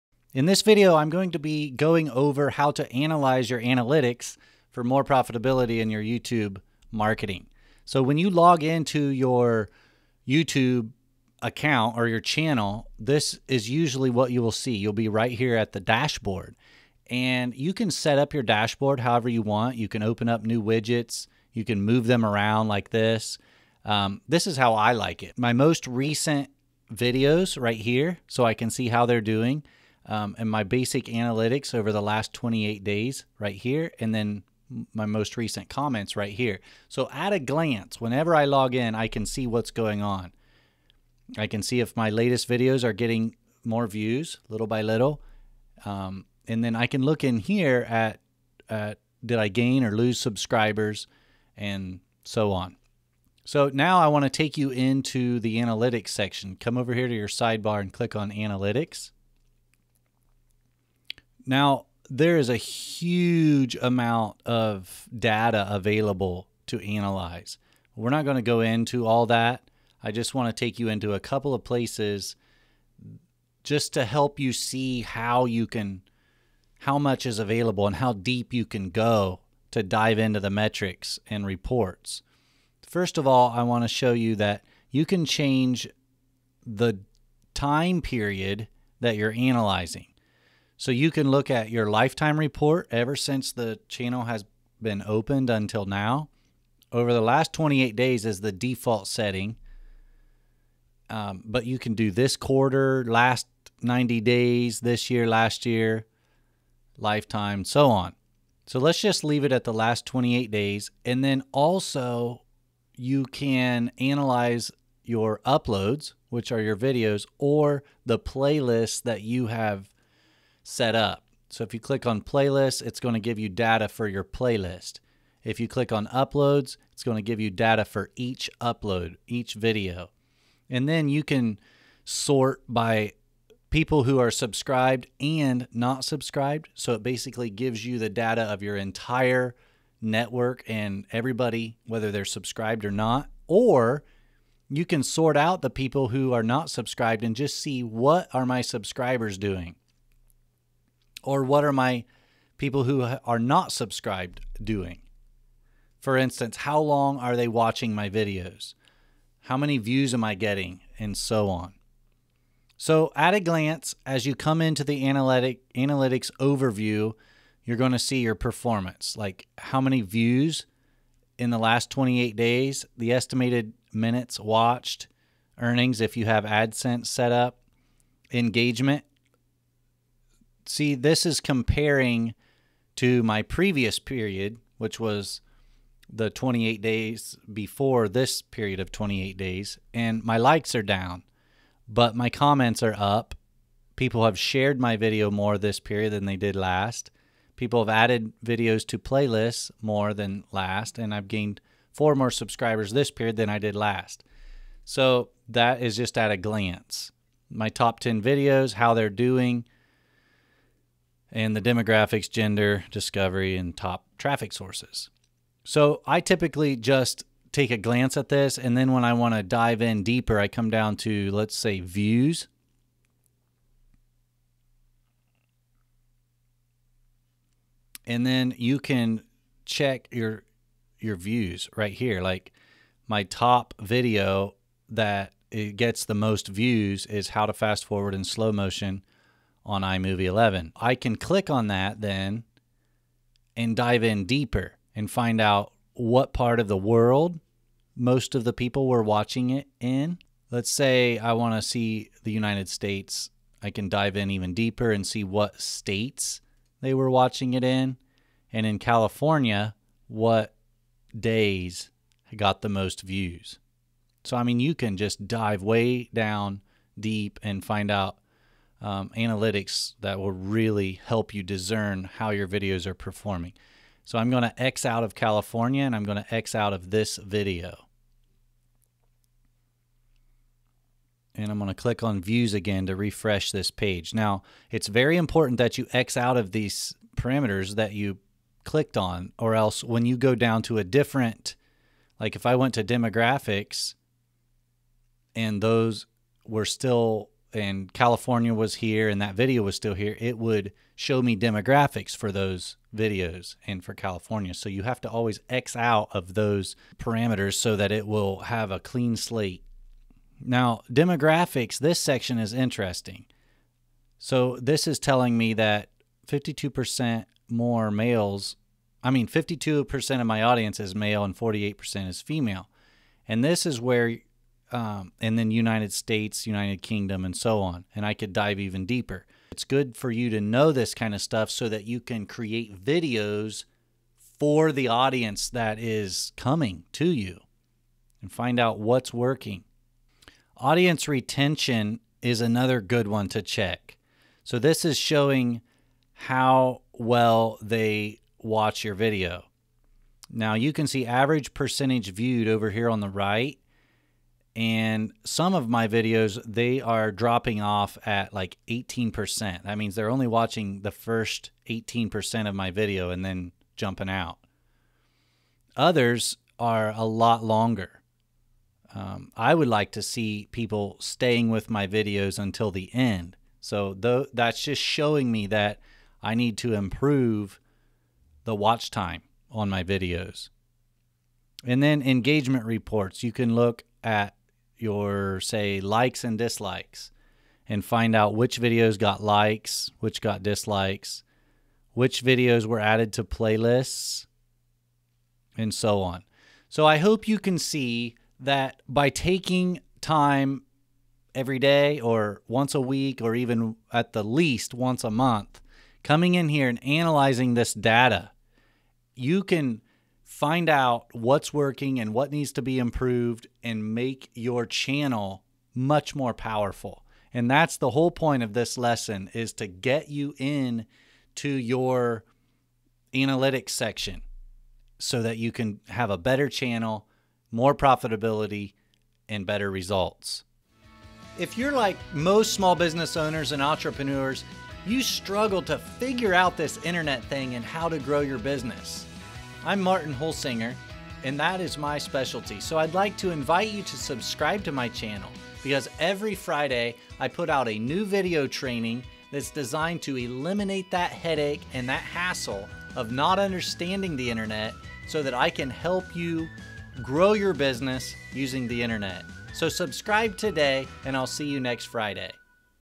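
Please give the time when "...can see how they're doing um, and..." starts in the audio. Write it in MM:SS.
00:28.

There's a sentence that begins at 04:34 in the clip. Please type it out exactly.
So I'm going to X out of California and I'm going to X out of this video.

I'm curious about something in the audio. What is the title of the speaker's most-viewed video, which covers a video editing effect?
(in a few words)
How to fast forward in slow motion on iMovie 11.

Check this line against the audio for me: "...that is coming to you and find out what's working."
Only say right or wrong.
right.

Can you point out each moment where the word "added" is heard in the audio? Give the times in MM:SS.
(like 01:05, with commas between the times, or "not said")
03:17, 06:32.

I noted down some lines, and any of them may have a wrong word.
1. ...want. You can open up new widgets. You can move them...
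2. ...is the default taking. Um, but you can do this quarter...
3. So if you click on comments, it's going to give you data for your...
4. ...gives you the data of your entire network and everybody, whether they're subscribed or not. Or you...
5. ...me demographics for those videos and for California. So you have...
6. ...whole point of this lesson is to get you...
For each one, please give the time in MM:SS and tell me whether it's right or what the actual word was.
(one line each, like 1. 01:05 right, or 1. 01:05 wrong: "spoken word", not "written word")
1. 00:19 right
2. 01:38 wrong: "setting", not "taking"
3. 02:01 wrong: "playlists", not "comments"
4. 02:17 right
5. 05:01 right
6. 06:57 right.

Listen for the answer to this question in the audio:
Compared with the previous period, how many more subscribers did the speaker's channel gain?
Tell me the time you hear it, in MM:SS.
03:21.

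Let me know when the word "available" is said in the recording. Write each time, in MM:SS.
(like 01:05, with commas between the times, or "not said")
01:05, 01:17.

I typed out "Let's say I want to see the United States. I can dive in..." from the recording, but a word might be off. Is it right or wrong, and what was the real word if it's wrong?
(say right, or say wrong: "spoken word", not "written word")
right.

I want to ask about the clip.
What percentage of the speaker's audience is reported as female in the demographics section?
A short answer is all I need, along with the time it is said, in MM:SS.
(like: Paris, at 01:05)
48%, at 05:21.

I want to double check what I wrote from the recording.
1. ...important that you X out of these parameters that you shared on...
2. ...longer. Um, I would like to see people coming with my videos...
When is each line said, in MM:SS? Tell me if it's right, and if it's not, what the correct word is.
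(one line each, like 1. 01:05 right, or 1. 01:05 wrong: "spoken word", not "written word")
1. 04:45 wrong: "clicked", not "shared"
2. 06:07 wrong: "staying", not "coming".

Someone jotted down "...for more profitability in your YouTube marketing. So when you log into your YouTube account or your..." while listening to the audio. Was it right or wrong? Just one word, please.
right.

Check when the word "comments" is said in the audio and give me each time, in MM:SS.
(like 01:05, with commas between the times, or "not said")
00:35, 03:12.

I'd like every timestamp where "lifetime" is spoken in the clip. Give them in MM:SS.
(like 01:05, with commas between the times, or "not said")
01:31, 01:46.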